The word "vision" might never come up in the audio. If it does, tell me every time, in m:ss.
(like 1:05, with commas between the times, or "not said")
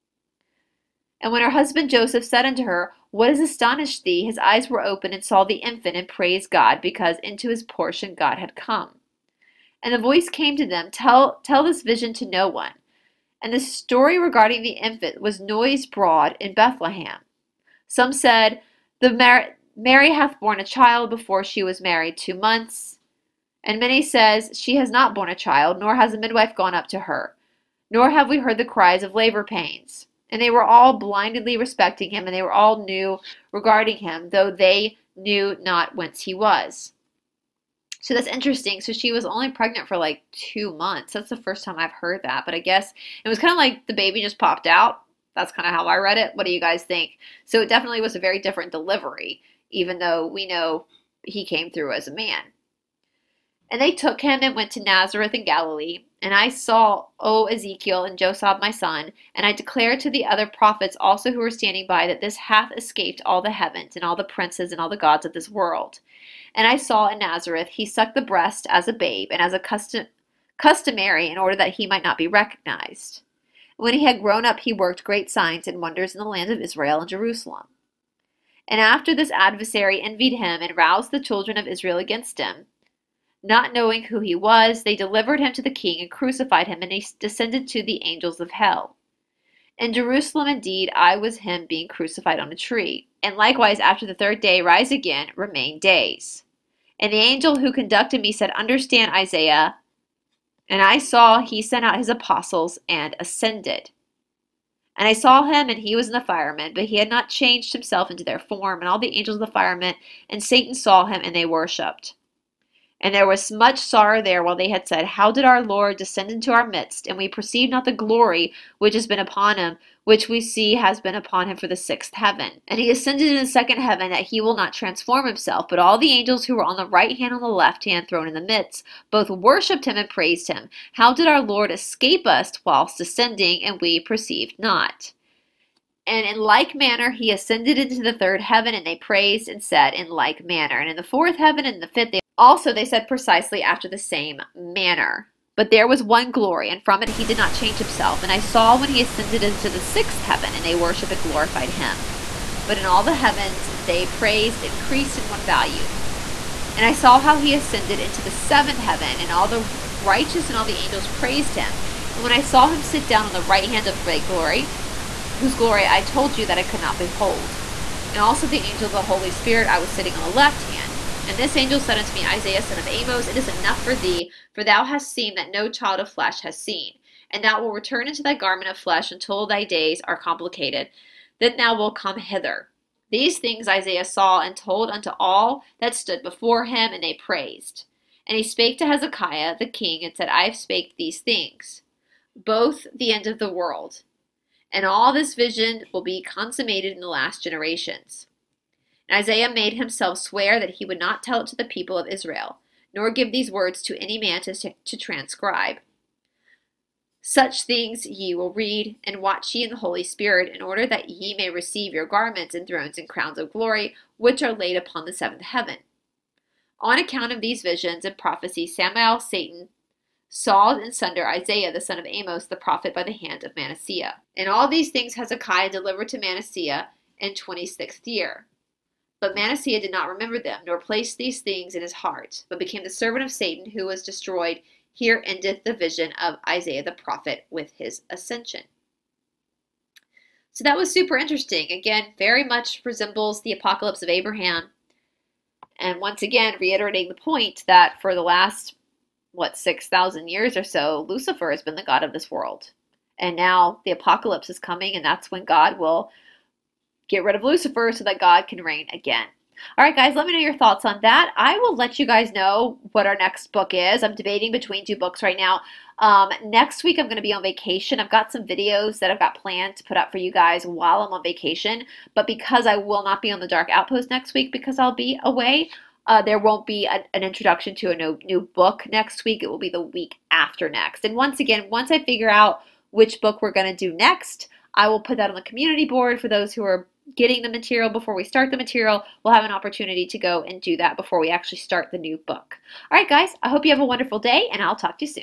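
0:11, 3:15, 3:37, 3:55.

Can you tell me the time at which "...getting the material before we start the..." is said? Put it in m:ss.
4:47.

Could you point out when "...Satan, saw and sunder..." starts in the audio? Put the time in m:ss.
3:39.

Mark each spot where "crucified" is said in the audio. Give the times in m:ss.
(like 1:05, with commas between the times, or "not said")
1:26, 1:31.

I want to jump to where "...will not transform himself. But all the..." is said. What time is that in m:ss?
2:04.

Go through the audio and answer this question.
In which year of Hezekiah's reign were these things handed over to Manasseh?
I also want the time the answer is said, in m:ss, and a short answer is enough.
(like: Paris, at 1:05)
26th year, at 3:47.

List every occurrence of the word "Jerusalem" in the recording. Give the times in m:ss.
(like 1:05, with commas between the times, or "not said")
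1:17, 1:29.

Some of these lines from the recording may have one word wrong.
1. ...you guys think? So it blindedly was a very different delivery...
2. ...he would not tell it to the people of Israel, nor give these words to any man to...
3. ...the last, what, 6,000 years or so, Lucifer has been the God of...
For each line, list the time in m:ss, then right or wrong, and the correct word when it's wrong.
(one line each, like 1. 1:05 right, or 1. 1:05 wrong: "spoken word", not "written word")
1. 0:46 wrong: "definitely", not "blindedly"
2. 3:20 right
3. 4:08 right.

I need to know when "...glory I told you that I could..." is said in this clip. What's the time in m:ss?
2:45.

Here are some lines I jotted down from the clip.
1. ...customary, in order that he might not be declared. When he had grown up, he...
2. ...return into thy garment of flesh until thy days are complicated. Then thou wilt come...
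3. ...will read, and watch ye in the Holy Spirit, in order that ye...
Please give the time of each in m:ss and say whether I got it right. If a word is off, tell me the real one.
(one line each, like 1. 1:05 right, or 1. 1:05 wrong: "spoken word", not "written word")
1. 1:10 wrong: "recognized", not "declared"
2. 2:57 right
3. 3:28 right.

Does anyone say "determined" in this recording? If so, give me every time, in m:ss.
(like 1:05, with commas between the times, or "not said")
not said.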